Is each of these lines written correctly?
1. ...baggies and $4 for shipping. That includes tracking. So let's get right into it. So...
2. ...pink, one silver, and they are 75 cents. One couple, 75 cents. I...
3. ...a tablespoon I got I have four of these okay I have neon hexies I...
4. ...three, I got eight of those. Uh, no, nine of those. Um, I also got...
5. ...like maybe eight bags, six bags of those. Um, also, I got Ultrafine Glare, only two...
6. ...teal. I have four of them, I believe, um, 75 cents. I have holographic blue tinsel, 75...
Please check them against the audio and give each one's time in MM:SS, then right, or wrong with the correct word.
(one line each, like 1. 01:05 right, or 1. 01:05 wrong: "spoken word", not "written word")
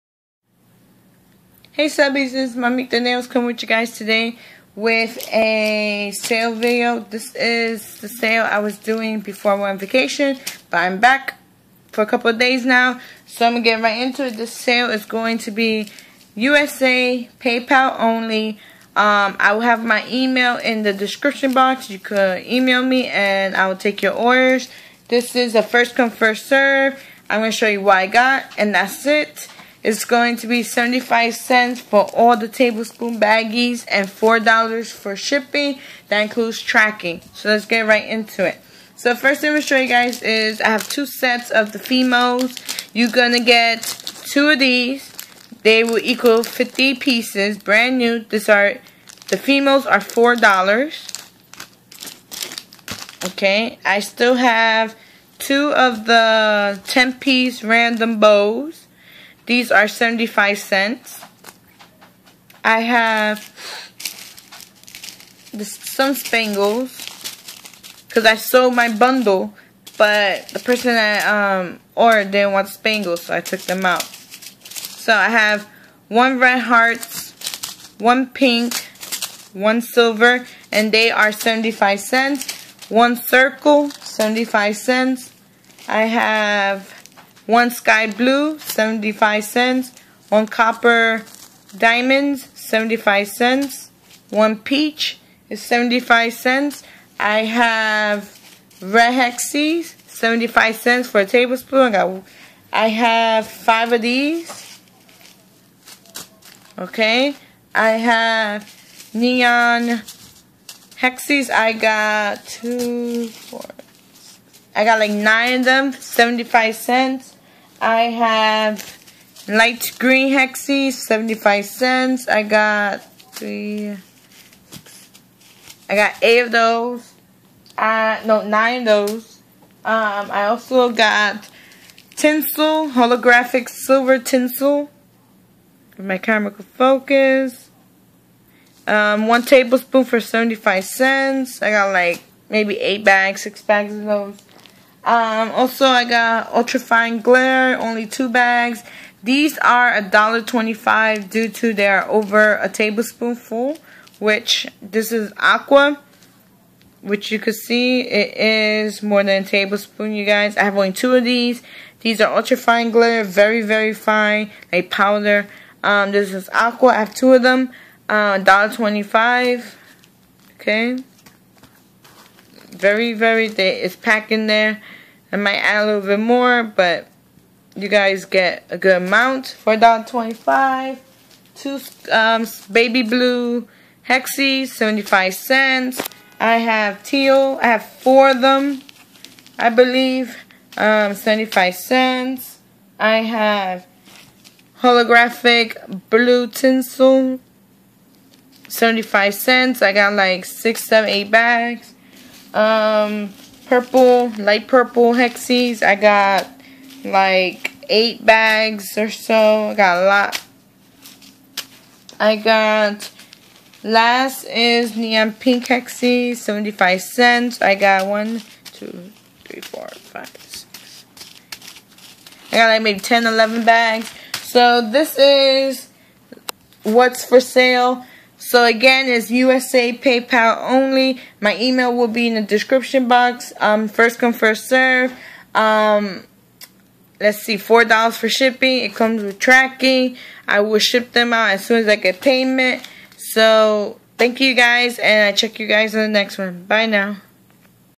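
1. 00:33 right
2. 01:18 wrong: "circle", not "couple"
3. 01:41 wrong: "five", not "four"
4. 02:03 right
5. 02:21 right
6. 03:07 right.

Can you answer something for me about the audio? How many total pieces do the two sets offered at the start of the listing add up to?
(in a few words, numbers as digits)
50.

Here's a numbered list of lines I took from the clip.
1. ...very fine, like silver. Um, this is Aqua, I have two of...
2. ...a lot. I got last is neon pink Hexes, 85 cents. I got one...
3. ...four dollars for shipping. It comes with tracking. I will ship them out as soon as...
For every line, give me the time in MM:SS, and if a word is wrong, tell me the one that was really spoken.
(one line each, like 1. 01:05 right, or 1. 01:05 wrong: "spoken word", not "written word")
1. 02:43 wrong: "powder", not "silver"
2. 03:30 wrong: "75", not "85"
3. 03:57 right.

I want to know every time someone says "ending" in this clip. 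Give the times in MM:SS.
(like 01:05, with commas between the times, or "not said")
not said.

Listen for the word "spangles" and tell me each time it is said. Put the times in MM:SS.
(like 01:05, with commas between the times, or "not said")
01:06, 01:12.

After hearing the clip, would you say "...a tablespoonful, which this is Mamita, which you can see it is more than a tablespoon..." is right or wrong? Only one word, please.
wrong.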